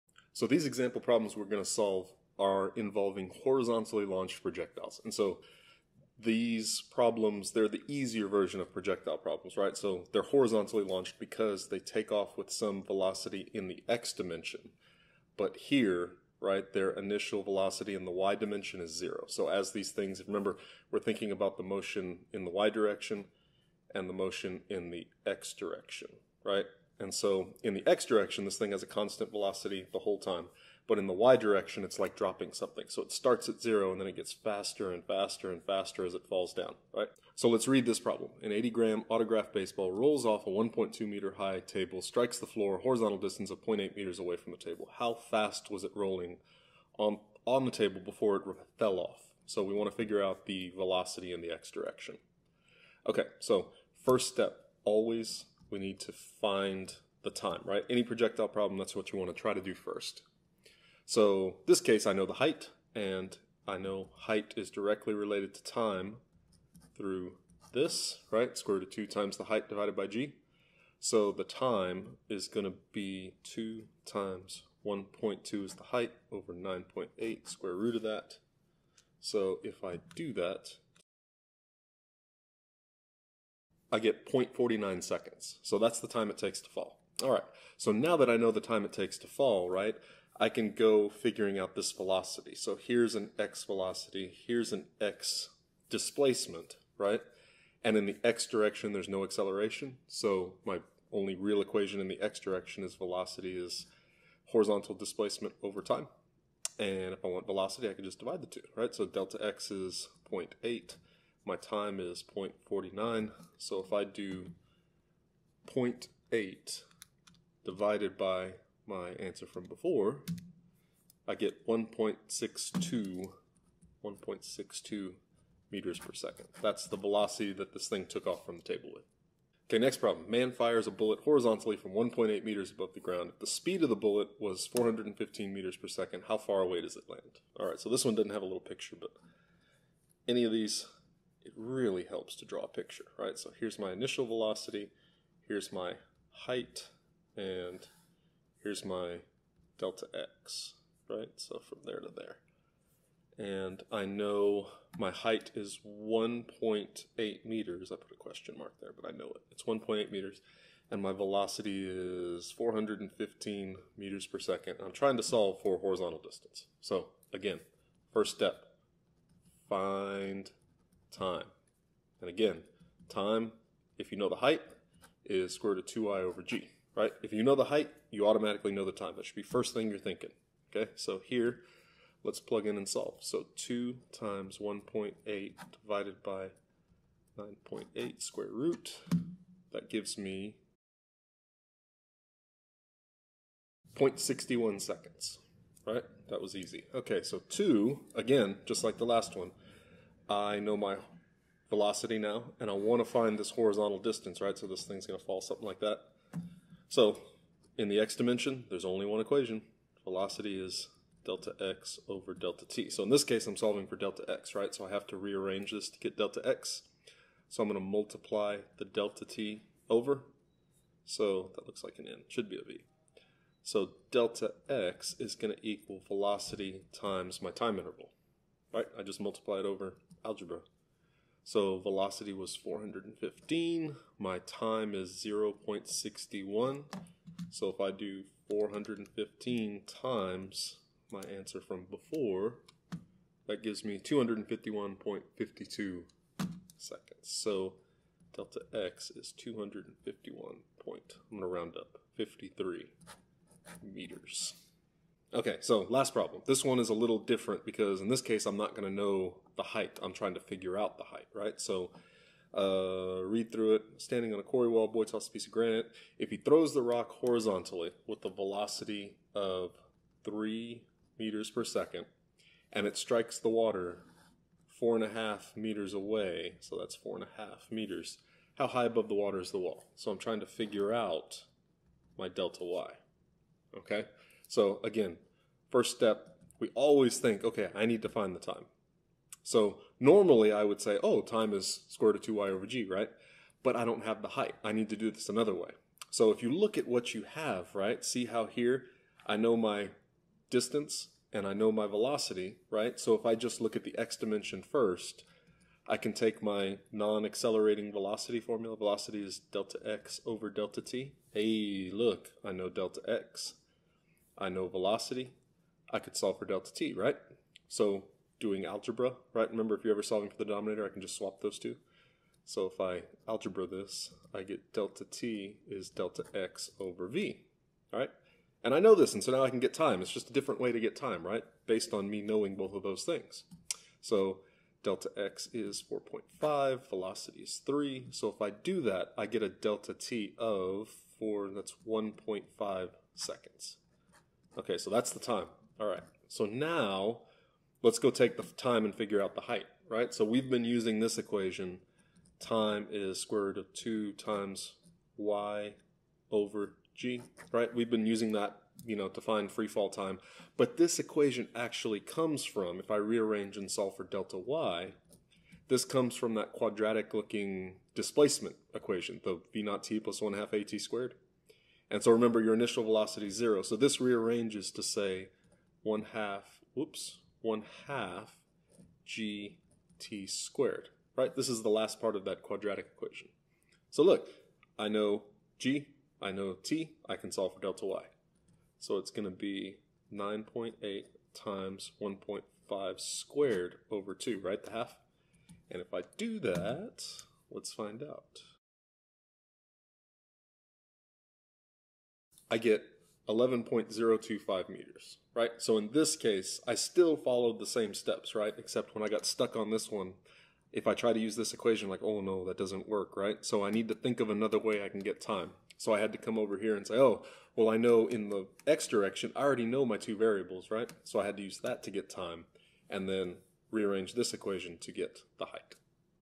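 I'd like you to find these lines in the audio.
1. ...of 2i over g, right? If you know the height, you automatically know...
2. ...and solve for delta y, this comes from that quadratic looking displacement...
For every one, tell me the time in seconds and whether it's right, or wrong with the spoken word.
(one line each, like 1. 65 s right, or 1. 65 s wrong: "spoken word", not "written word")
1. 175 s right
2. 363 s right.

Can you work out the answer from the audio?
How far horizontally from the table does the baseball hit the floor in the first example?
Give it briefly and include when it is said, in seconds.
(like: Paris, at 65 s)
0.8 meters, at 43 s.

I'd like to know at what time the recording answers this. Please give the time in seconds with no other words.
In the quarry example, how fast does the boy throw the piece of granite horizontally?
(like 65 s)
270 s.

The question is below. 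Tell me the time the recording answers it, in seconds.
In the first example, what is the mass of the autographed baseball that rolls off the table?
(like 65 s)
38 s.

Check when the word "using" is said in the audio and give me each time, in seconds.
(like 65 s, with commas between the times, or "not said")
350 s, 358 s.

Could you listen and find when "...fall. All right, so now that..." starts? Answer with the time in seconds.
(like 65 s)
86 s.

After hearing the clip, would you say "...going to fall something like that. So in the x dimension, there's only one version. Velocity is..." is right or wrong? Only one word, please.
wrong.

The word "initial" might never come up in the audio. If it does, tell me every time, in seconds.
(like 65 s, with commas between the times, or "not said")
16 s, 143 s, 372 s.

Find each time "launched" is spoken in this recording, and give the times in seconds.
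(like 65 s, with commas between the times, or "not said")
4 s, 10 s.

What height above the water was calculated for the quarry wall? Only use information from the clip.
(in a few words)
11.025 meters.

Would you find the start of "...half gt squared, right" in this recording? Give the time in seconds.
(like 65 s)
377 s.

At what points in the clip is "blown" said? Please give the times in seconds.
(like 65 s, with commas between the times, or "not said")
not said.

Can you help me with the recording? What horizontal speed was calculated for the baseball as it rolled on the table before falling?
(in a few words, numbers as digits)
1.62 meters per second.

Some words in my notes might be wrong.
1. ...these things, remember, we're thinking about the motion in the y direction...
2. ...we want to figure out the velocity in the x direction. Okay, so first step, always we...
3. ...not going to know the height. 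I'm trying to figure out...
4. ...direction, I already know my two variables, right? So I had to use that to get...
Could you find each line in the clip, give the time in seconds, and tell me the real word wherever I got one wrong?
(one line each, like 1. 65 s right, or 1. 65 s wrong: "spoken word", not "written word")
1. 19 s right
2. 49 s right
3. 258 s right
4. 418 s right.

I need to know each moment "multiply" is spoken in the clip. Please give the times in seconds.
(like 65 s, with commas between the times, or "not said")
217 s, 229 s.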